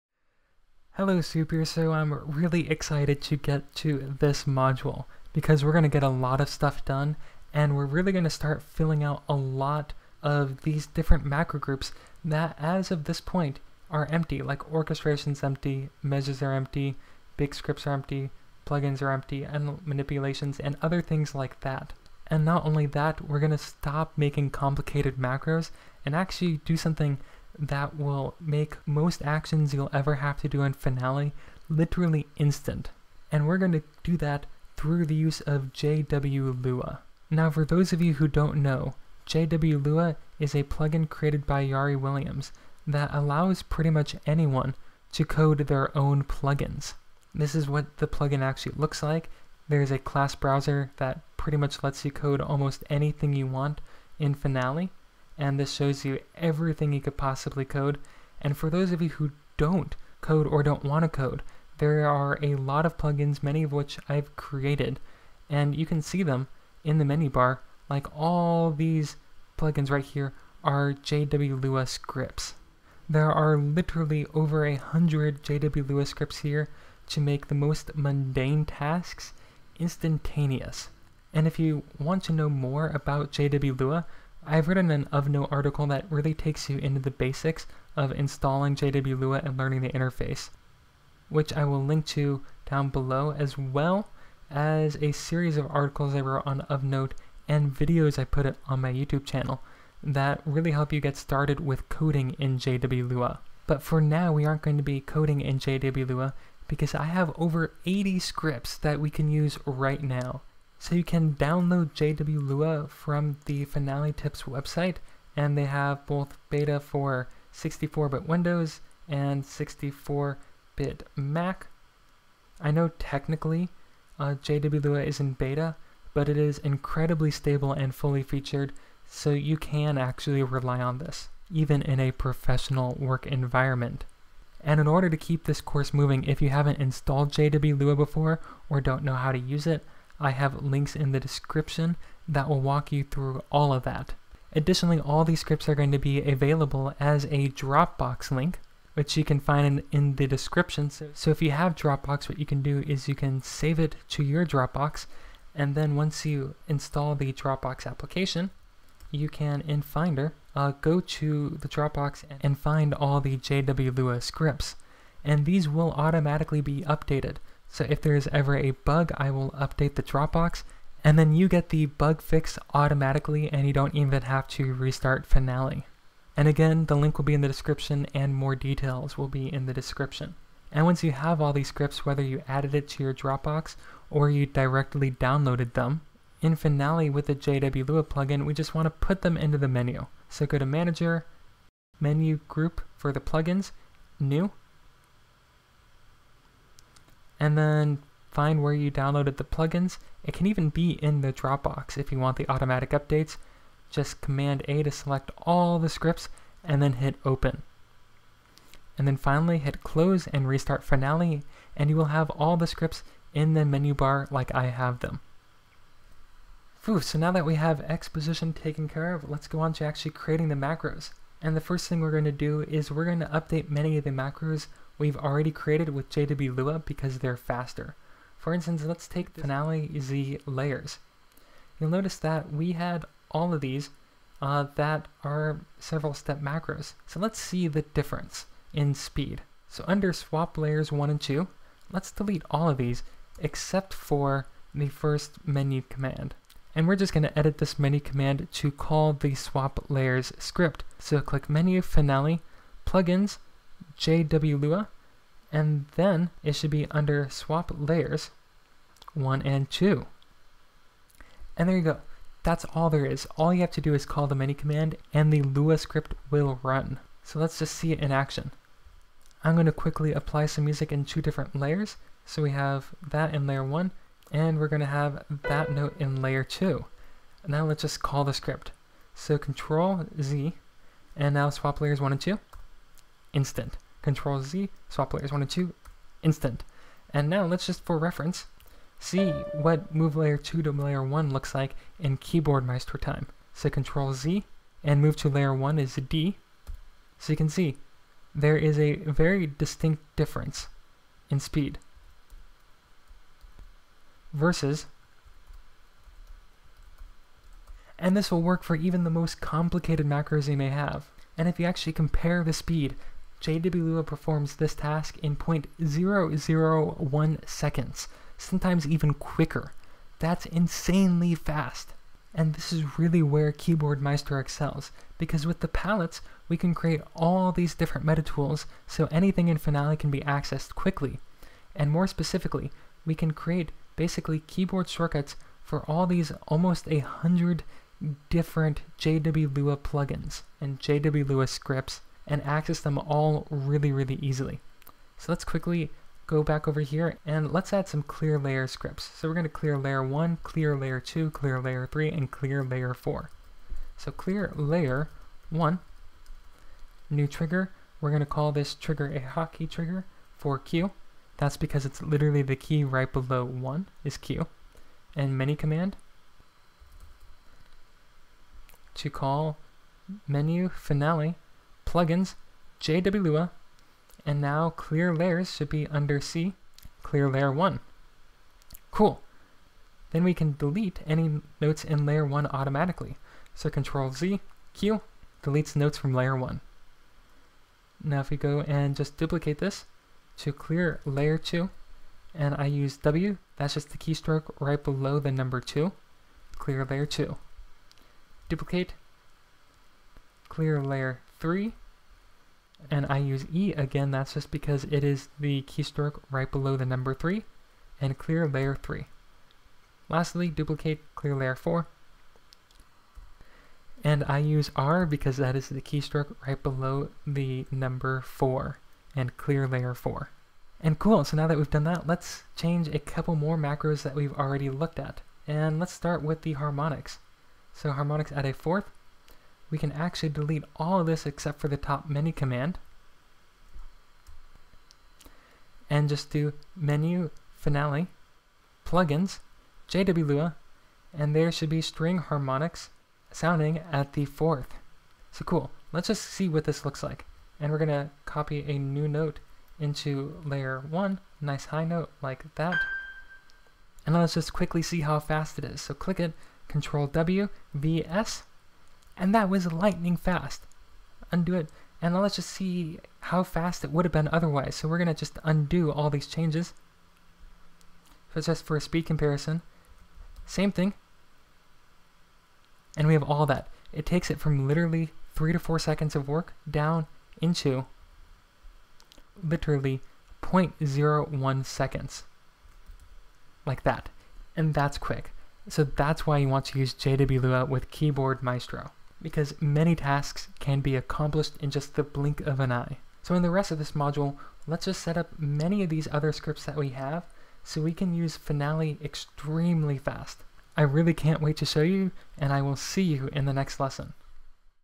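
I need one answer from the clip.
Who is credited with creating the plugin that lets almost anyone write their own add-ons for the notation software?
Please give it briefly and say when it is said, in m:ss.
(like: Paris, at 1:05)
Jari Williamsson, at 0:41.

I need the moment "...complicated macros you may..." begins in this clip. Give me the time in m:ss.
5:09.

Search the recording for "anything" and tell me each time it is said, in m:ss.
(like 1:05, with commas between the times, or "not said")
0:52, 5:29.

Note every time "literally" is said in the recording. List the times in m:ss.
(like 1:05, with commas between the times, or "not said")
0:31, 1:13, 6:02, 7:54, 7:59.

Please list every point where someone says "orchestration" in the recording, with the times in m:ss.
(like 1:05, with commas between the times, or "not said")
0:14.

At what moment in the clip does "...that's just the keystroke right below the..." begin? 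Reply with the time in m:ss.
6:33.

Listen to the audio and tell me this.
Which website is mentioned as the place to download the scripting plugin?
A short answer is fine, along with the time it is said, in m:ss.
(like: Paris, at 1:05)
Finale Tips, at 1:53.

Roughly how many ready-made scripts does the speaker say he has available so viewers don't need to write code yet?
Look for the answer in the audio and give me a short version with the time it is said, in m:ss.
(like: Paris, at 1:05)
80, at 1:47.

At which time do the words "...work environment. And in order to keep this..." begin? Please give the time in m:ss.
2:12.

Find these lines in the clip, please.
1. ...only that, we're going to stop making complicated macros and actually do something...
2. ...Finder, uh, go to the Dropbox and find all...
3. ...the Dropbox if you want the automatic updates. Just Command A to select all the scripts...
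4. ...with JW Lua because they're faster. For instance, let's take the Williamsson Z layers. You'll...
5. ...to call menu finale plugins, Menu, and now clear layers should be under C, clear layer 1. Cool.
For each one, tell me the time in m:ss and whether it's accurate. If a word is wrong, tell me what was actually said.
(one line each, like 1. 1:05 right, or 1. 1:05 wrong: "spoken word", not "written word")
1. 0:22 right
2. 2:39 right
3. 3:21 right
4. 3:45 wrong: "Finale", not "Williamsson"
5. 6:08 wrong: "JWLua", not "Menu".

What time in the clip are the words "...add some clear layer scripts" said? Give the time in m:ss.
5:47.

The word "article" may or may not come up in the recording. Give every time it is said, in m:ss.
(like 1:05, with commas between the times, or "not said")
1:25, 1:35.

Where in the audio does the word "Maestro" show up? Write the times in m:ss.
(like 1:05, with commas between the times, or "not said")
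4:52, 5:23, 8:08.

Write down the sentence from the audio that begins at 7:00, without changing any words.
And cool, so now that we've done that, let's change a couple more macros that we've already looked at.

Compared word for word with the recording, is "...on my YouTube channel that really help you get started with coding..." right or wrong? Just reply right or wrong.
right.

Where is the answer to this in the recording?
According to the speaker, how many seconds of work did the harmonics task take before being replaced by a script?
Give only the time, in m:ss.
7:55.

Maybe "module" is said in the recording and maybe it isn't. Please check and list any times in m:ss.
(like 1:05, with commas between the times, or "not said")
0:04, 8:13.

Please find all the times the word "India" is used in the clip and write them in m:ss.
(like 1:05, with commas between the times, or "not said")
not said.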